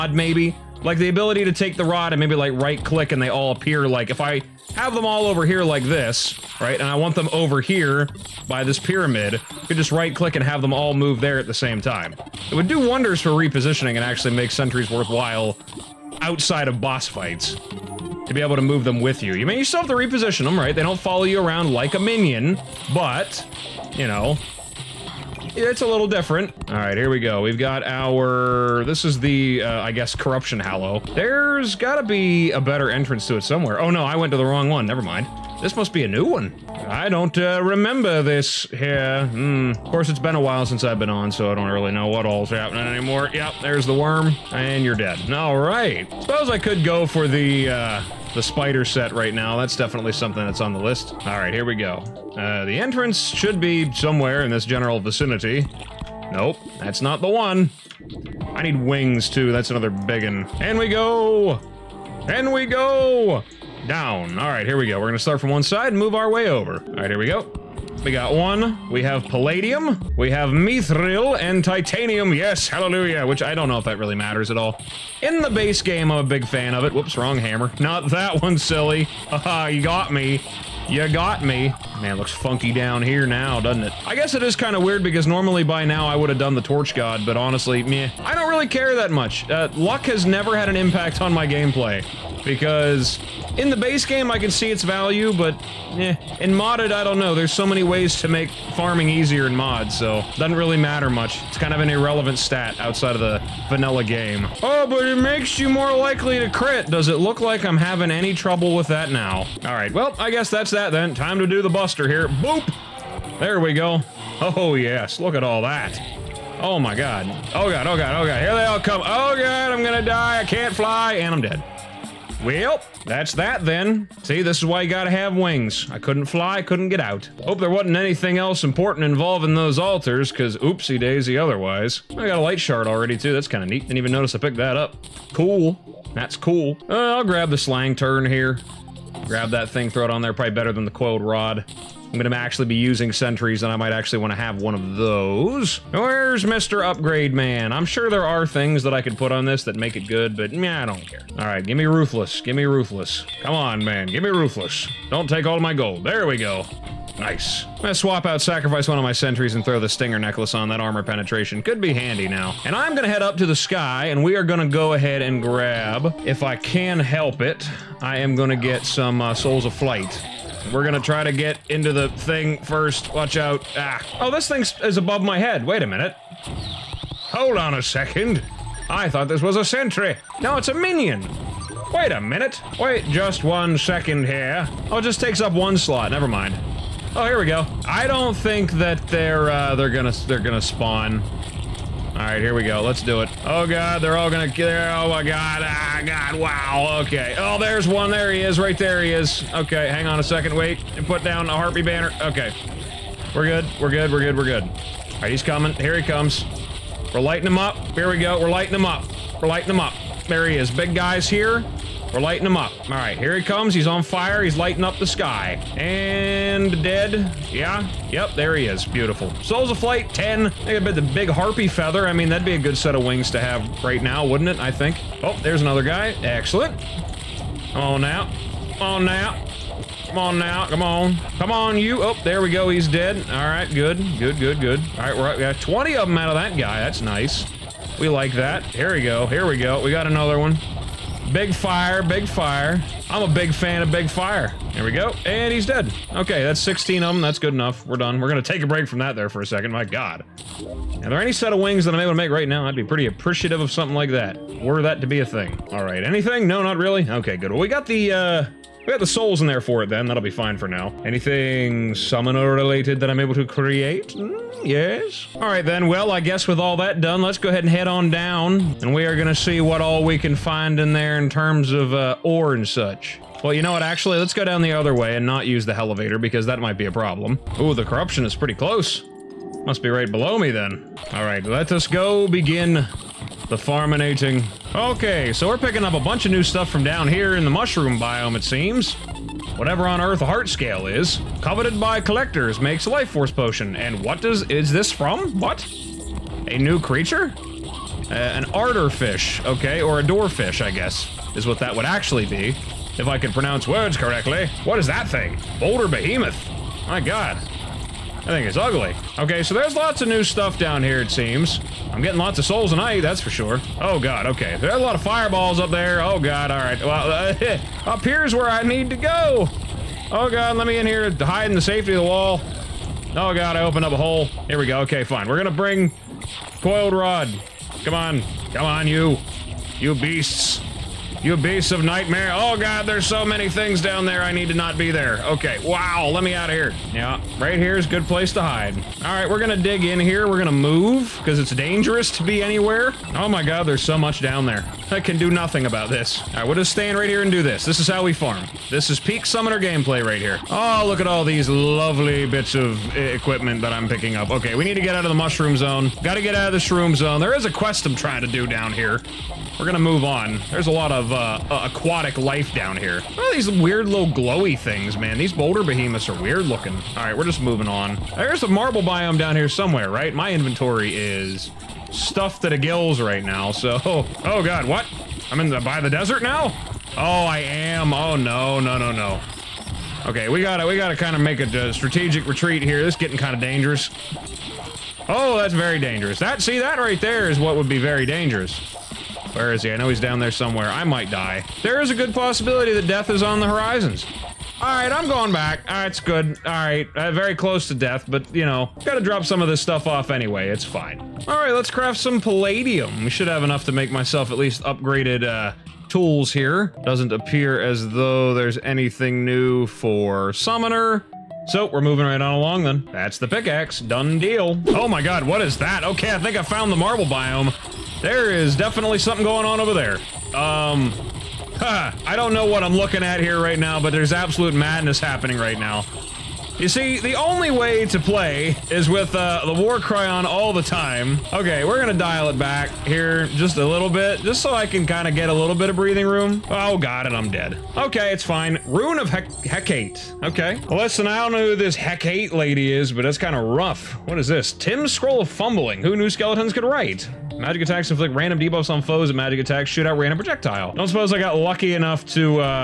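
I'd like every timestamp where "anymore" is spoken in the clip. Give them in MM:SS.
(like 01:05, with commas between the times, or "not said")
00:42.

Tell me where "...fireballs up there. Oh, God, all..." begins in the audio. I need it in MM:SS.
05:15.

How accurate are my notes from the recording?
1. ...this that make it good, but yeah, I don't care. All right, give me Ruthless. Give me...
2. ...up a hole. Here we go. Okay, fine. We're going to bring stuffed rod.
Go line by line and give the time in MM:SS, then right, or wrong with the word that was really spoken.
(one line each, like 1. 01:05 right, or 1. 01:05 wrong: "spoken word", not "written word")
1. 02:29 right
2. 05:23 wrong: "coiled", not "stuffed".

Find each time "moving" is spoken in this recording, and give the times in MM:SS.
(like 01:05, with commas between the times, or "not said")
06:07, 06:51.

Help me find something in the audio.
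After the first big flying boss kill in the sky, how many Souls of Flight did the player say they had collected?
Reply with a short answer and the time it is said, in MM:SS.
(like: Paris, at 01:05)
10, at 03:39.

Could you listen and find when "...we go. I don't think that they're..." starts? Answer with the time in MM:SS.
03:07.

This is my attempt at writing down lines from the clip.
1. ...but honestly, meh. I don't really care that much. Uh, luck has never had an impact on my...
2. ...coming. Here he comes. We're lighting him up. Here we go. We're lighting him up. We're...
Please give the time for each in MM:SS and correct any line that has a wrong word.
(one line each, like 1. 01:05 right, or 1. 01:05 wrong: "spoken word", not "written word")
1. 01:27 right
2. 03:25 right.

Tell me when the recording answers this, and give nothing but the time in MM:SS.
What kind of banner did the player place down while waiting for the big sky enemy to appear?
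03:21.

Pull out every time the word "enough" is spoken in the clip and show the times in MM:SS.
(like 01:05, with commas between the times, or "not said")
04:07, 06:43, 07:31.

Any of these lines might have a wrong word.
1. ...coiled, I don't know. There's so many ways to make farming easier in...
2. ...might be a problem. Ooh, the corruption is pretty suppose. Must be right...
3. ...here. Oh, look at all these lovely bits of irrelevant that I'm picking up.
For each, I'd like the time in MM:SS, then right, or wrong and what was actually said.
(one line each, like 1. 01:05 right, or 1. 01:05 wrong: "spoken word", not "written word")
1. 01:36 wrong: "modded", not "coiled"
2. 04:36 wrong: "close", not "suppose"
3. 05:50 wrong: "equipment", not "irrelevant".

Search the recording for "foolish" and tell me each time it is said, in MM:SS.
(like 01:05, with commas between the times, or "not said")
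not said.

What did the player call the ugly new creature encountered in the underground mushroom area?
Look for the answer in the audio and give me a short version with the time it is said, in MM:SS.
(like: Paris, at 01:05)
Boulder behemoth, at 05:05.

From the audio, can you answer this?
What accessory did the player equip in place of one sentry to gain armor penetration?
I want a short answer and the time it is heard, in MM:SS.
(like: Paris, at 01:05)
Stinger Necklace, at 02:39.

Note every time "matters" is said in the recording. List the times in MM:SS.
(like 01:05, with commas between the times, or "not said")
01:14, 01:40.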